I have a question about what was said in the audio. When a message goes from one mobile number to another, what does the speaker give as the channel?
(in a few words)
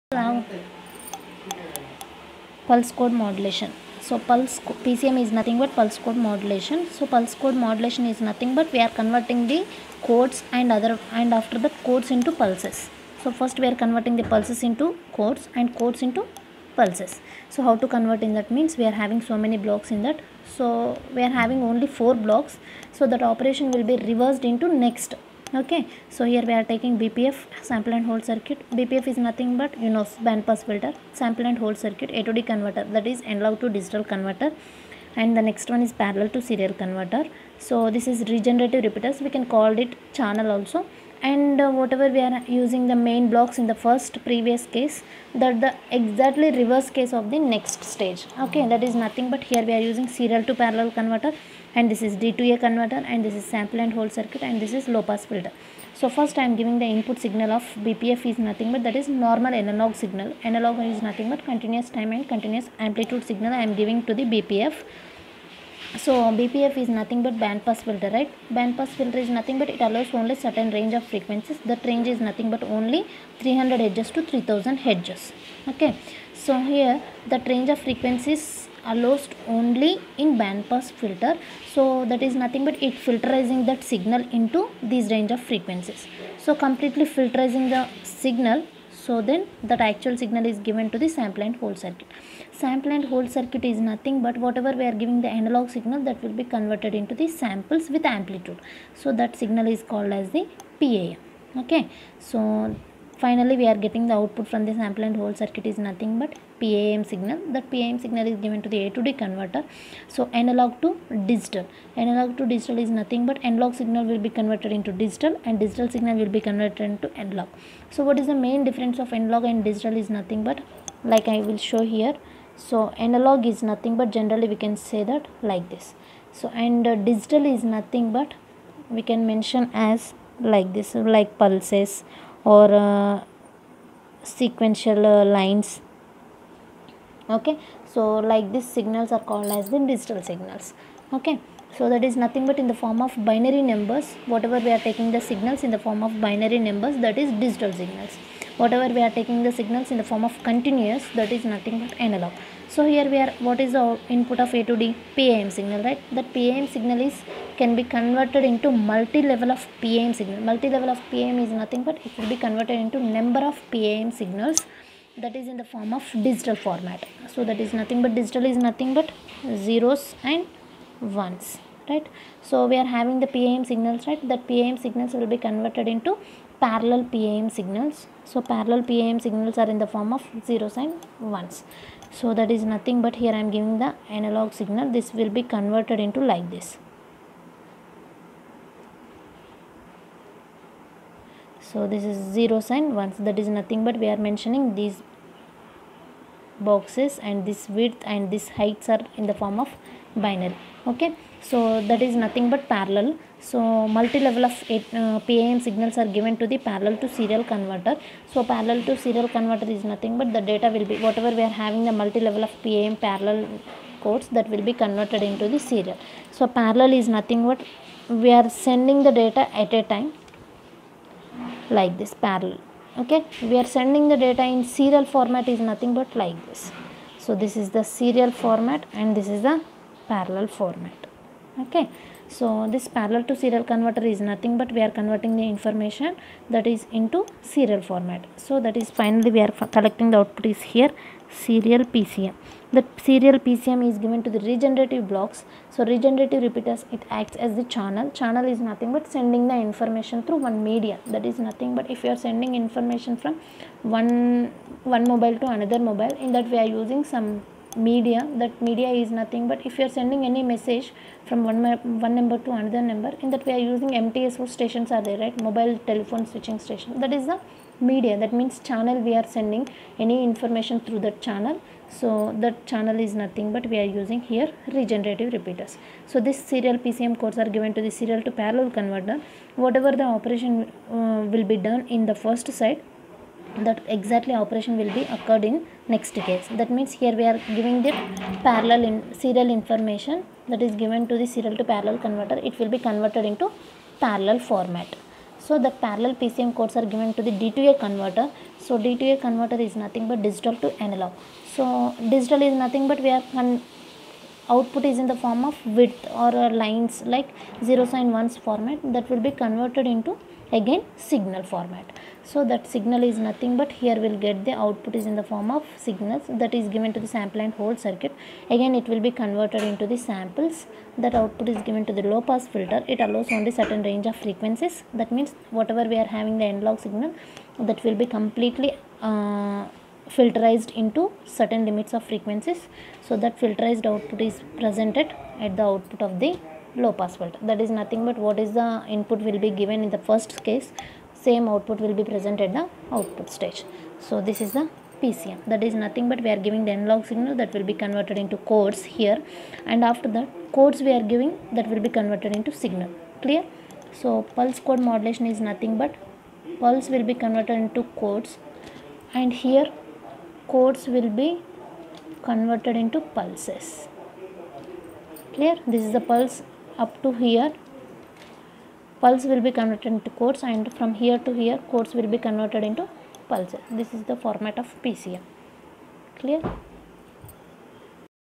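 mobile telephone switching station.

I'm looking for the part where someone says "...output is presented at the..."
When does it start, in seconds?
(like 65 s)
333 s.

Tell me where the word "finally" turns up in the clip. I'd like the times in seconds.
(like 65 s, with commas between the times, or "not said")
103 s, 238 s.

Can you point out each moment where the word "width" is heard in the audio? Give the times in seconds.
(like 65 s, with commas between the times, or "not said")
197 s, 305 s.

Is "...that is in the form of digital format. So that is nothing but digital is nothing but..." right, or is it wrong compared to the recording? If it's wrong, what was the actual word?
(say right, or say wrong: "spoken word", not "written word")
right.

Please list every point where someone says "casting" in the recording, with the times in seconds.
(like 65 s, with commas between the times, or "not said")
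not said.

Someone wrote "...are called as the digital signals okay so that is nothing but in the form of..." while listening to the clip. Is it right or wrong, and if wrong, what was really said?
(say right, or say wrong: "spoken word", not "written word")
right.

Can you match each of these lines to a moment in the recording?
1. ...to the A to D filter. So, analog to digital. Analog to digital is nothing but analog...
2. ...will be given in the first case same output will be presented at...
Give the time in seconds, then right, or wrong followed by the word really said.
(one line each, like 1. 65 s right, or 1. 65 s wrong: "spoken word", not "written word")
1. 108 s wrong: "converter", not "filter"
2. 339 s right.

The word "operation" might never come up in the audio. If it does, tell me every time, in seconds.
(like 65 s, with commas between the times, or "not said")
23 s, 280 s, 284 s.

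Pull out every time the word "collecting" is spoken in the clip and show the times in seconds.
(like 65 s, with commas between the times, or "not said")
239 s.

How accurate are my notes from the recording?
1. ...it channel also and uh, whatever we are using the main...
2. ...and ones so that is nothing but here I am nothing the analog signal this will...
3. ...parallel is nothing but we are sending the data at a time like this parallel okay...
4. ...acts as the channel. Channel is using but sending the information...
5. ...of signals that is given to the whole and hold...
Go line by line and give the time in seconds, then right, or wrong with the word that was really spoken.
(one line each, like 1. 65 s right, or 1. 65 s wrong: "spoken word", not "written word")
1. 39 s right
2. 180 s wrong: "giving", not "nothing"
3. 216 s right
4. 247 s wrong: "nothing", not "using"
5. 315 s wrong: "sample", not "whole".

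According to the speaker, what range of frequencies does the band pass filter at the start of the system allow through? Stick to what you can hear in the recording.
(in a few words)
300 Hz to 3000 Hz.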